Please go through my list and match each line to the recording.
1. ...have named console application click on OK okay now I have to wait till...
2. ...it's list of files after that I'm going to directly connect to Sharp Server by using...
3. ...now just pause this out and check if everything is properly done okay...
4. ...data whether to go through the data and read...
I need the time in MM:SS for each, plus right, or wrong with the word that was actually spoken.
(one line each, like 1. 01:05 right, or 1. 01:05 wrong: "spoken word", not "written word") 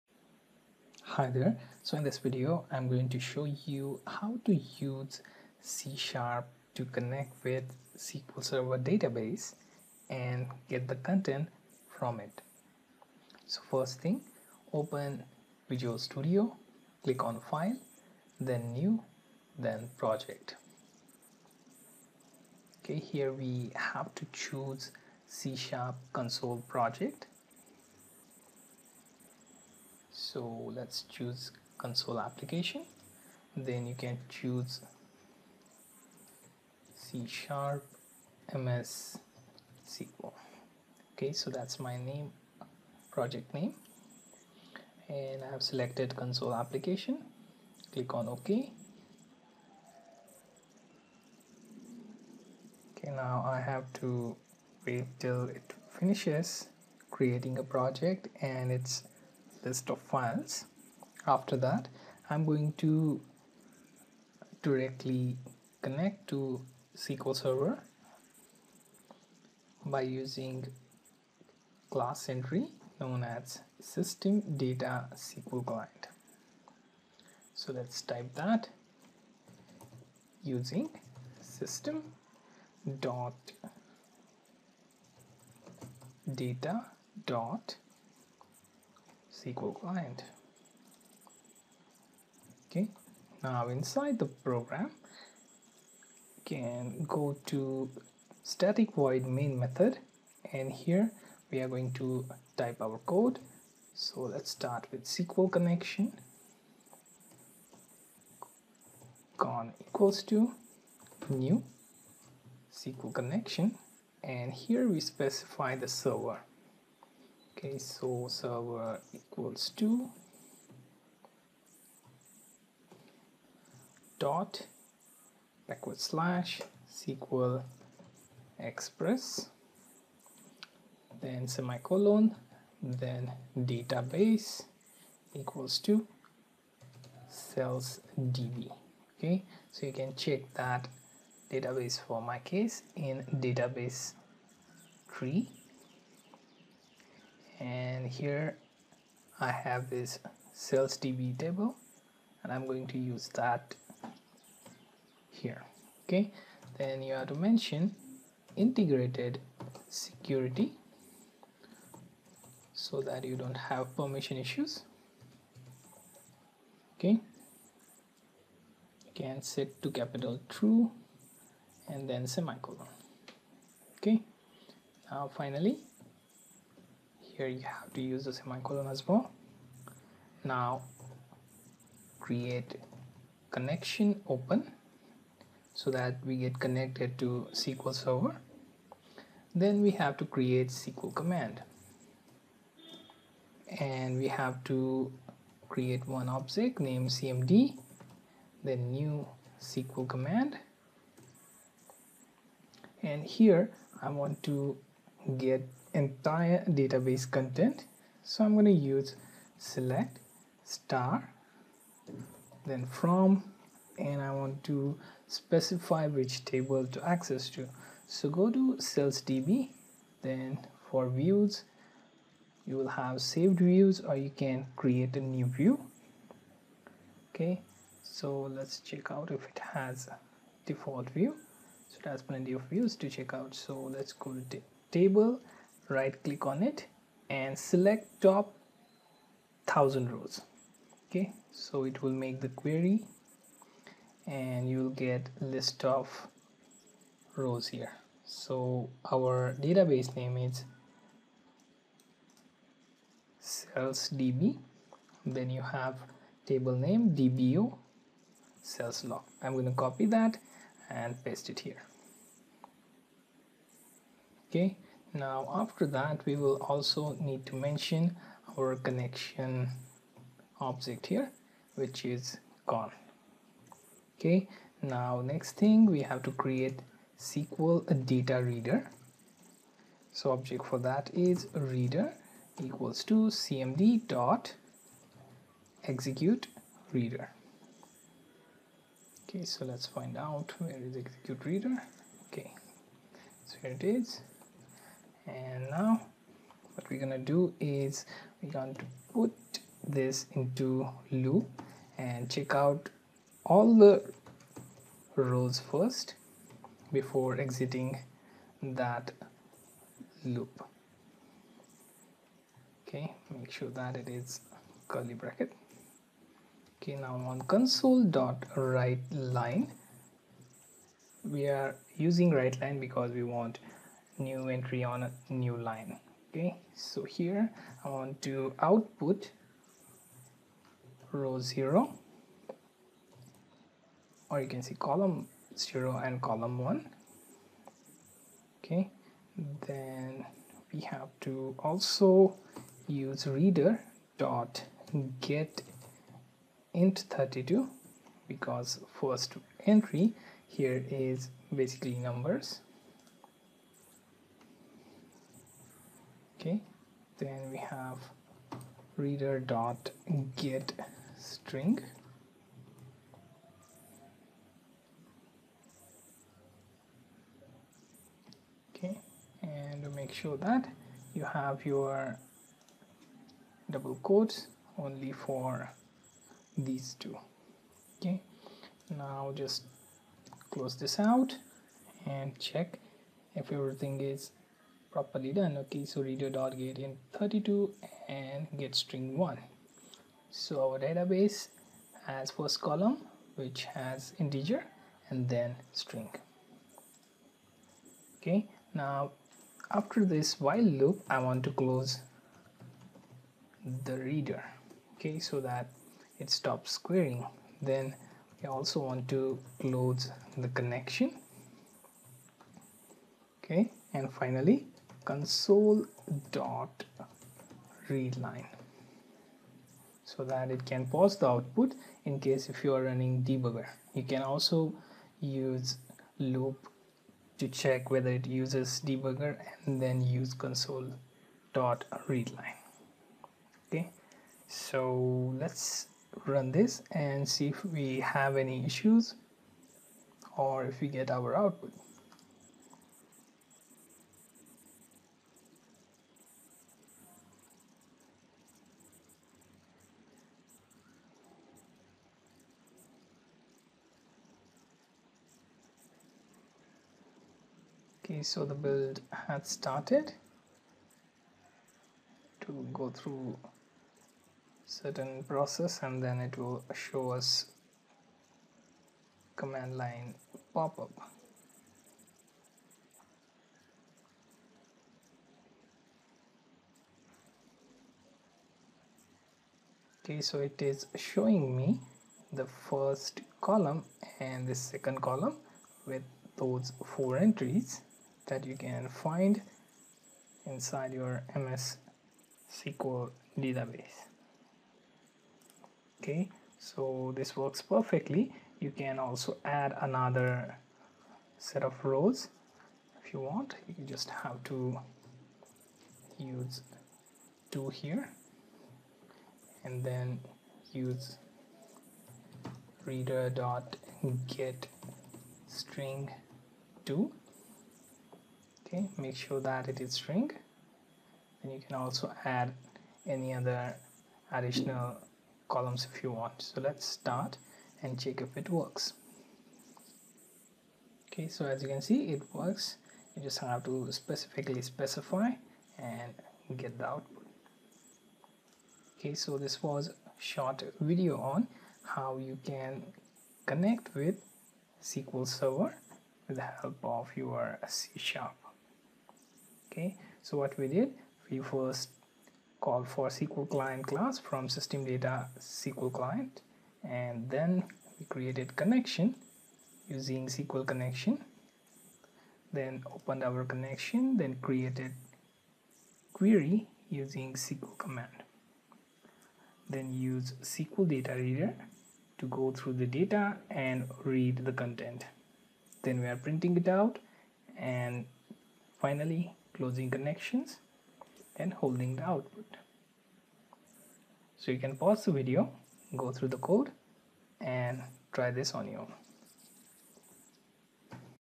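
1. 00:45 wrong: "selected", not "named"
2. 00:58 wrong: "SQL", not "Sharp"
3. 06:18 wrong: "close", not "pause"
4. 09:30 wrong: "reader", not "whether".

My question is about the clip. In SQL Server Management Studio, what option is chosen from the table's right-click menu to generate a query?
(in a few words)
Select top thousand rows.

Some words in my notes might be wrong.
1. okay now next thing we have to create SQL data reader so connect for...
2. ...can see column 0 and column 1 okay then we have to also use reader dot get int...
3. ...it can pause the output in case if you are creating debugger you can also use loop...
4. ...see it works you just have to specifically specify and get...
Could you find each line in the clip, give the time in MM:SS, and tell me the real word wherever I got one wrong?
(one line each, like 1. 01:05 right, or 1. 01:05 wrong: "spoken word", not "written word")
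1. 04:34 wrong: "object", not "connect"
2. 05:34 right
3. 07:00 wrong: "running", not "creating"
4. 08:51 right.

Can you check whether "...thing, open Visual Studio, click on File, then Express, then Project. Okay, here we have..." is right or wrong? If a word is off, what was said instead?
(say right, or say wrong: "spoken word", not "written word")
wrong: "New", not "Express".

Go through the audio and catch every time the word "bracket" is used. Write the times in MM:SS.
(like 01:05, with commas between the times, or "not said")
05:15.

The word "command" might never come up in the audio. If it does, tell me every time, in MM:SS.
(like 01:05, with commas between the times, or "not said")
03:11, 03:20, 07:49, 09:27.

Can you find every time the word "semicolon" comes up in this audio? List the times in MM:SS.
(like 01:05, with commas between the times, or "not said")
02:11, 02:52, 02:58.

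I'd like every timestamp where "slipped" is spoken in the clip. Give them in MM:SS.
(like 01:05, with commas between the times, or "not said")
not said.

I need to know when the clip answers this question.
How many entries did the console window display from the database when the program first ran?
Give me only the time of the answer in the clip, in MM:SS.
08:06.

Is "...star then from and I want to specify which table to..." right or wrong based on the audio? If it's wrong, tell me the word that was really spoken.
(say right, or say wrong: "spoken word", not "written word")
right.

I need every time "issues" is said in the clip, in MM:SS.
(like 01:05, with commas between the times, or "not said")
02:44, 07:18.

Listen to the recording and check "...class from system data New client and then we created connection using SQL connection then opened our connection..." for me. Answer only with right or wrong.
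wrong.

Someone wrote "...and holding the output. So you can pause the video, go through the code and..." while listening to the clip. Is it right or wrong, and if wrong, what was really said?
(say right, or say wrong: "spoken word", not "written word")
right.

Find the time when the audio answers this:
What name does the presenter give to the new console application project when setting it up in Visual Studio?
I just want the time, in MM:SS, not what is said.
00:36.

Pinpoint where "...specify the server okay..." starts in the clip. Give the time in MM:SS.
01:54.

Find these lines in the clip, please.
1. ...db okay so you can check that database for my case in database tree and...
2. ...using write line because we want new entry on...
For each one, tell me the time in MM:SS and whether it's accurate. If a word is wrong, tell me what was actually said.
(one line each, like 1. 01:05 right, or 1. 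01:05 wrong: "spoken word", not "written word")
1. 02:18 right
2. 05:21 right.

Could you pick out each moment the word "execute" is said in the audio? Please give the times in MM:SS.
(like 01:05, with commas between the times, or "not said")
04:45, 04:50.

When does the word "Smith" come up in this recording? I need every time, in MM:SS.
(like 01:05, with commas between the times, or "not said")
not said.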